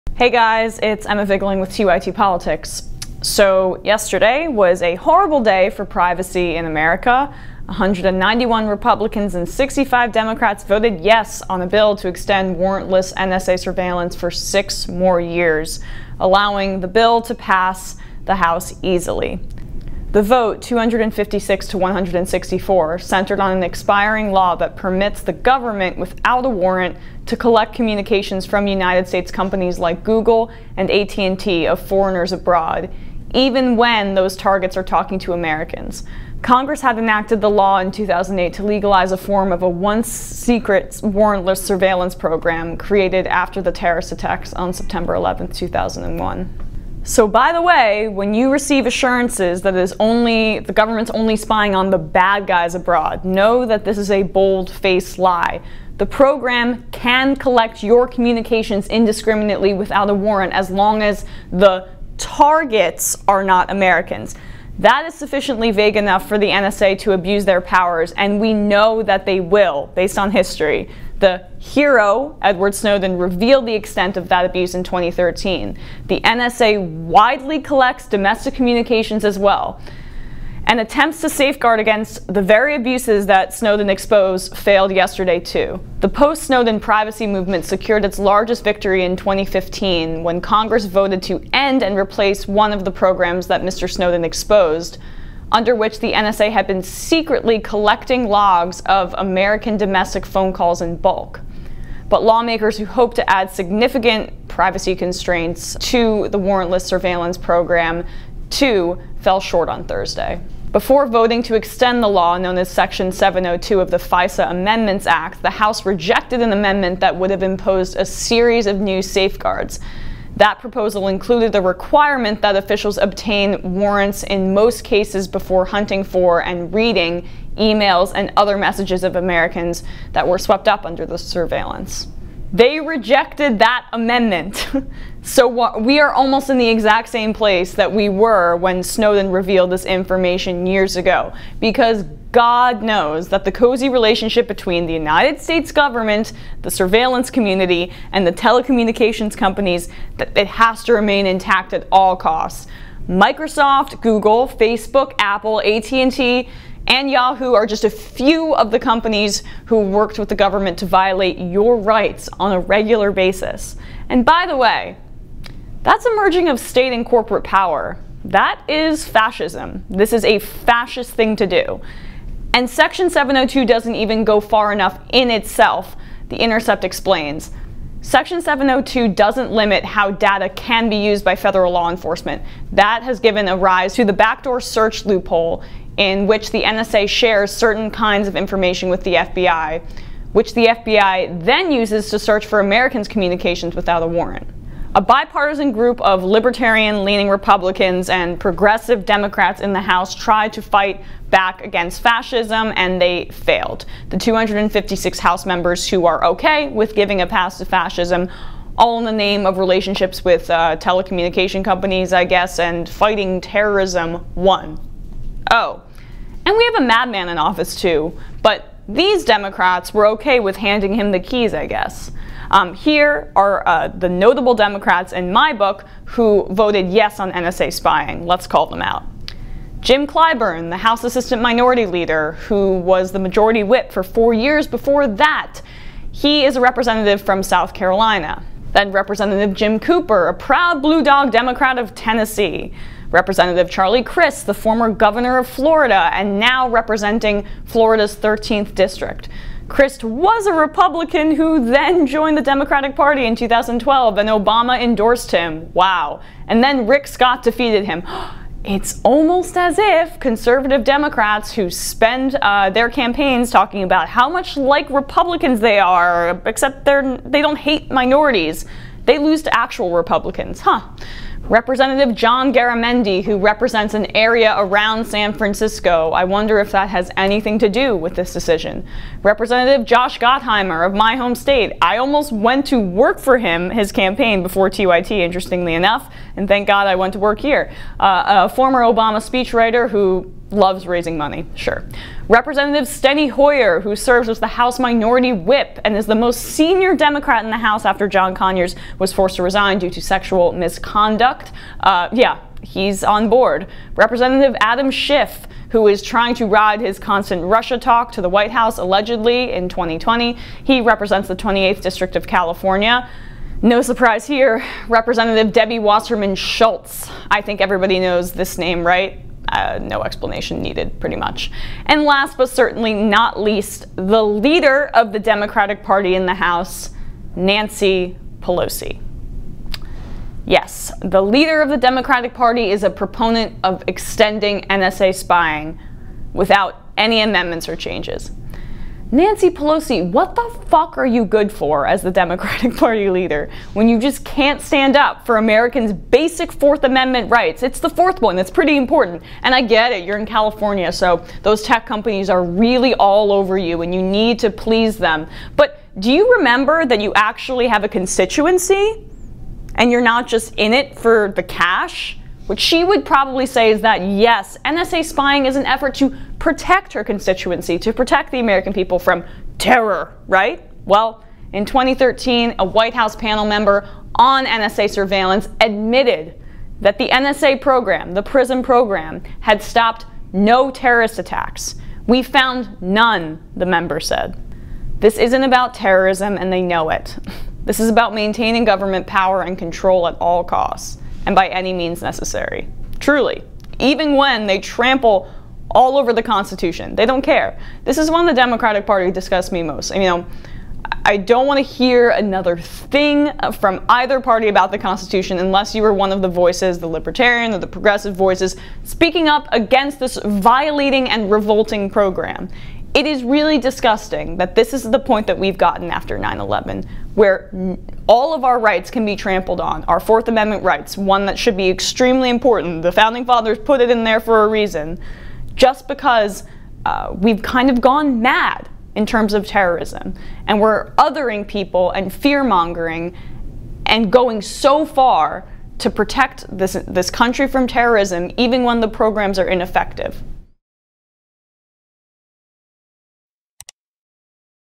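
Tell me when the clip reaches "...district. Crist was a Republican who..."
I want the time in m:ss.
4:08.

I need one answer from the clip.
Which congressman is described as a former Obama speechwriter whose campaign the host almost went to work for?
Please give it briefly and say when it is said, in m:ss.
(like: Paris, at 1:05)
Josh Gottheimer, at 4:39.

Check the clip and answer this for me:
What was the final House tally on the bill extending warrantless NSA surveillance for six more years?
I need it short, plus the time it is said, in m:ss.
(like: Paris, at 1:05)
256 to 164, at 0:20.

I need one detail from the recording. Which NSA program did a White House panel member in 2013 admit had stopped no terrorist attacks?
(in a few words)
PRISM.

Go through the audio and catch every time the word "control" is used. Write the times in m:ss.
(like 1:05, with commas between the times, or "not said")
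6:29.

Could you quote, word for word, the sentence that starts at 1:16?
The NSA widely collects domestic communications as well.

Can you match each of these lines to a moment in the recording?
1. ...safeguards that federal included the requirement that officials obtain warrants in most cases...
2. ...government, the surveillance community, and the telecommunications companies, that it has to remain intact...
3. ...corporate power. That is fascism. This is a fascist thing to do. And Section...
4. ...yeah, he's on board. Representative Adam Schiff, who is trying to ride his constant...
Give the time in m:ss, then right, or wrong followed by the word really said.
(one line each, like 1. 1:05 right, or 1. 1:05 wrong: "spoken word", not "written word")
1. 1:59 wrong: "proposal", not "federal"
2. 2:25 right
3. 2:47 right
4. 5:02 right.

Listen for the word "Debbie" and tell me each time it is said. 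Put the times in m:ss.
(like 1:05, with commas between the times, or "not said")
5:15.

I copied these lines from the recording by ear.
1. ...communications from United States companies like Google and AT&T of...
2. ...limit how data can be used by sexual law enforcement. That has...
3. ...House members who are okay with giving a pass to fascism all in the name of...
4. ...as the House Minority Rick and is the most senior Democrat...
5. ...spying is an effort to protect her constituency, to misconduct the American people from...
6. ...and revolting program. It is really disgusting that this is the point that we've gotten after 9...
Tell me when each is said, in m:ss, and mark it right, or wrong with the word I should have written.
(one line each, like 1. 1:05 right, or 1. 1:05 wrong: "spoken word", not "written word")
1. 0:27 right
2. 2:59 wrong: "federal", not "sexual"
3. 3:25 right
4. 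4:54 wrong: "Whip", not "Rick"
5. 6:05 wrong: "protect", not "misconduct"
6. 6:51 right.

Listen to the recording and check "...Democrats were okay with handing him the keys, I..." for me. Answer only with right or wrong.
right.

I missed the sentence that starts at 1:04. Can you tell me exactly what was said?
That is sufficiently vague enough for the NSA to abuse their powers, and we know that they will based on history.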